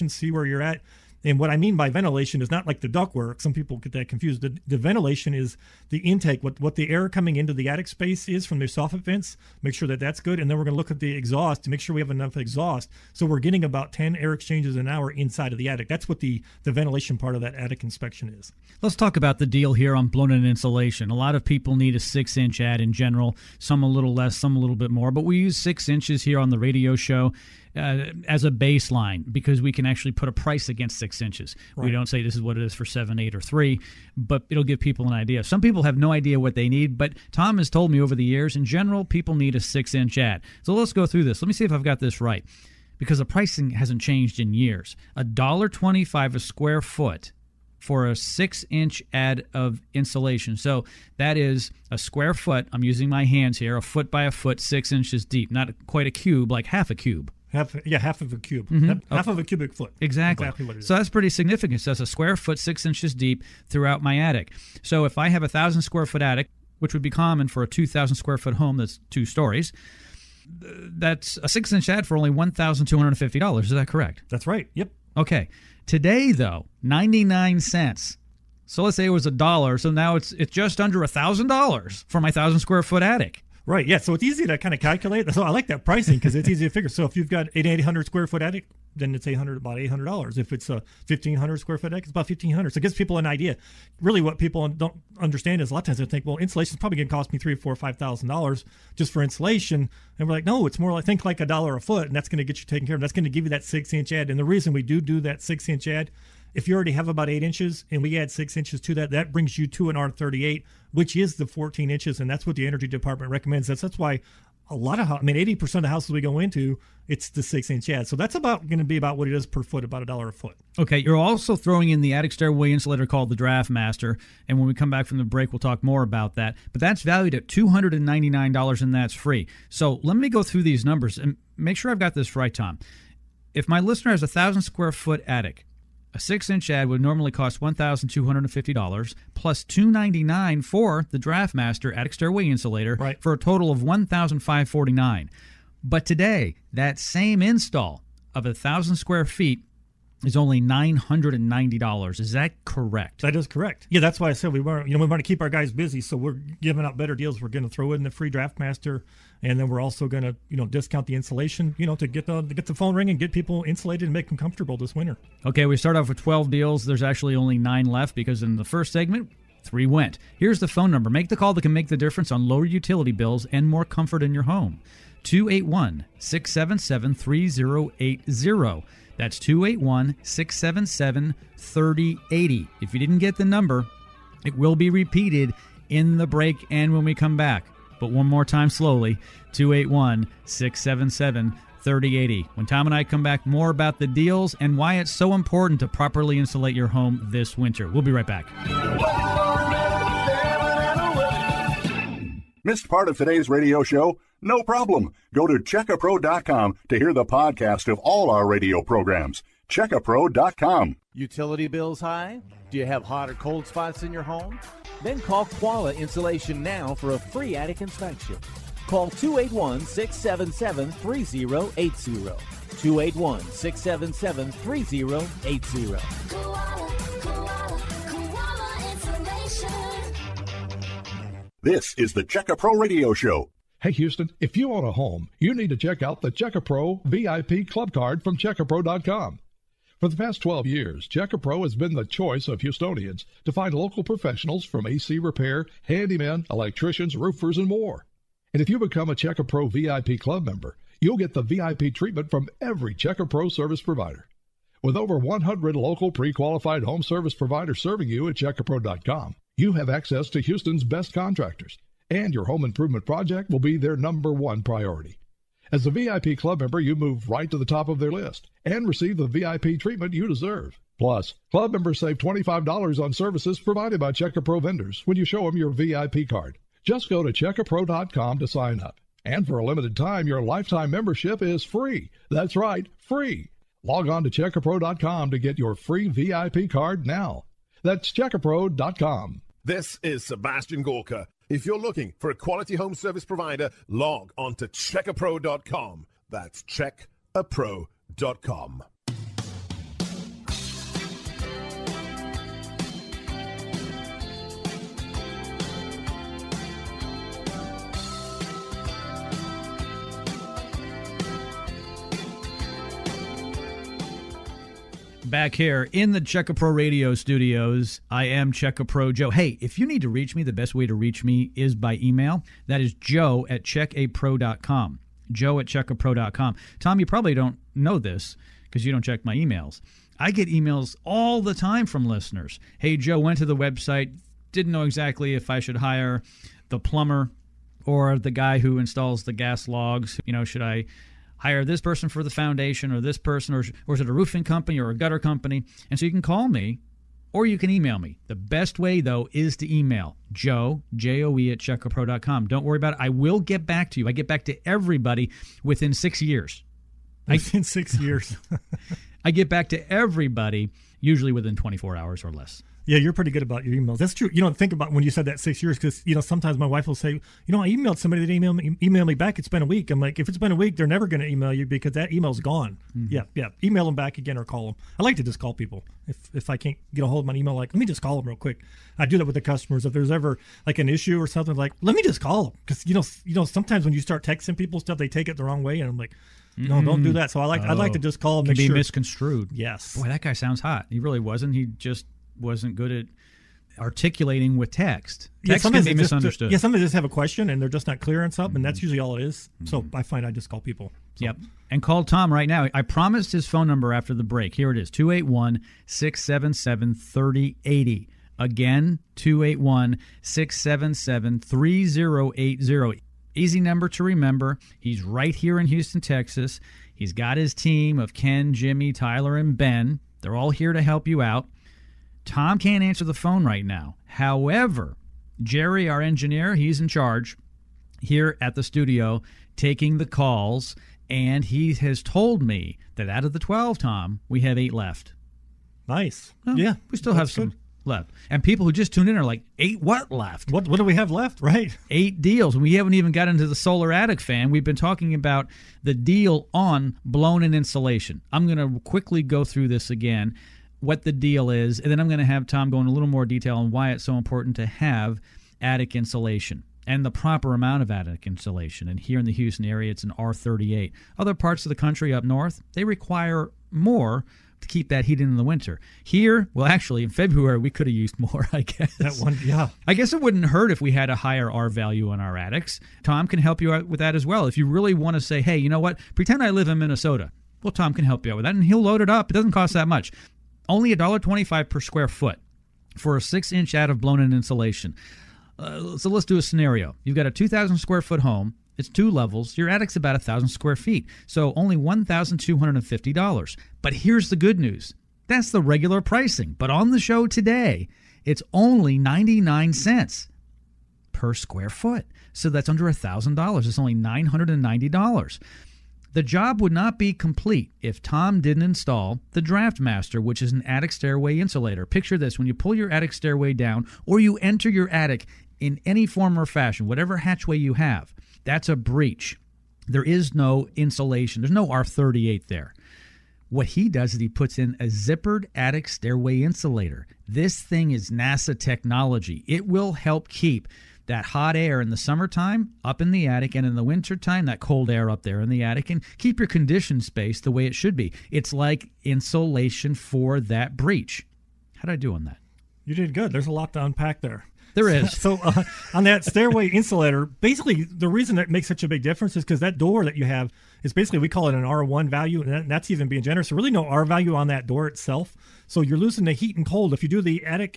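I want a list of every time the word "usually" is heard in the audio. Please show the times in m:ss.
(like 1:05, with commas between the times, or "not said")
6:00, 6:38.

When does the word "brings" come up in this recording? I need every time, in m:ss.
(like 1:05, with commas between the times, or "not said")
1:49.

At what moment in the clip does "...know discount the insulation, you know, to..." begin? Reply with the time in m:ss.
2:40.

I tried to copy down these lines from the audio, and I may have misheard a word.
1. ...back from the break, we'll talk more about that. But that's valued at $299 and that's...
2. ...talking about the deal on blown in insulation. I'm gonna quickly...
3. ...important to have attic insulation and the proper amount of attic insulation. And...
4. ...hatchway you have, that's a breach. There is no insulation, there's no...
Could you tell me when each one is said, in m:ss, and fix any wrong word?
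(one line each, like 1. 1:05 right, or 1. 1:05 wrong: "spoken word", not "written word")
1. 2:04 right
2. 7:24 right
3. 7:34 right
4. 8:37 right.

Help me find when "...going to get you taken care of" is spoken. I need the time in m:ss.
1:42.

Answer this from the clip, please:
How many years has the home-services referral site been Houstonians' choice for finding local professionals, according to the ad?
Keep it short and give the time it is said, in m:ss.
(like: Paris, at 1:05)
12, at 4:00.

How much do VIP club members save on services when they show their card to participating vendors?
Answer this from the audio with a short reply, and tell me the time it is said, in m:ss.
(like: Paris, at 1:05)
$25, at 4:32.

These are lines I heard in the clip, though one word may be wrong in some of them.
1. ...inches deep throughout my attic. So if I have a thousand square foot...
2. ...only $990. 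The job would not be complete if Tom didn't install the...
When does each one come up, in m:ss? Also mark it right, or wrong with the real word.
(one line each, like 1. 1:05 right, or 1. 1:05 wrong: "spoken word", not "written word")
1. 1:02 right
2. 8:23 right.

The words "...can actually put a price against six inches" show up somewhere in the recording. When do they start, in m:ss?
0:29.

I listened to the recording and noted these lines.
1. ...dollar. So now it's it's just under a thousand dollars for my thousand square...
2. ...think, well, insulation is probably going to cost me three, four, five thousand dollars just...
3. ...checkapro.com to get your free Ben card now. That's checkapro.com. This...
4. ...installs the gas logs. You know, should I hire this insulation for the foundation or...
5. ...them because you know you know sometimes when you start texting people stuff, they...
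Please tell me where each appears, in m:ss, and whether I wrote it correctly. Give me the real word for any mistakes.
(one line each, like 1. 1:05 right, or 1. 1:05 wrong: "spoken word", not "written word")
1. 1:19 right
2. 1:36 right
3. 4:44 wrong: "VIP", not "Ben"
4. 5:38 wrong: "person", not "insulation"
5. 6:22 right.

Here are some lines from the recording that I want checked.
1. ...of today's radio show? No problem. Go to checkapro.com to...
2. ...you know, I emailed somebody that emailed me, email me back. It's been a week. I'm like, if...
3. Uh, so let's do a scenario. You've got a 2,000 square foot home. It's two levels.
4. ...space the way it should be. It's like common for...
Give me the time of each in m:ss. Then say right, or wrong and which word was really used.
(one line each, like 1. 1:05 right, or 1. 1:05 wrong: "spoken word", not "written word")
1. 3:23 right
2. 6:07 right
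3. 8:05 right
4. 8:57 wrong: "insulation", not "common".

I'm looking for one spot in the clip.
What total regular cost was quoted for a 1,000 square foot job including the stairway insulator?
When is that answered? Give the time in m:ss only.
2:23.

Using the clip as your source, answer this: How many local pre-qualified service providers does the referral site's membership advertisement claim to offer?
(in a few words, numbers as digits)
over 100.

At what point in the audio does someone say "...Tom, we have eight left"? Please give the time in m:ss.
7:13.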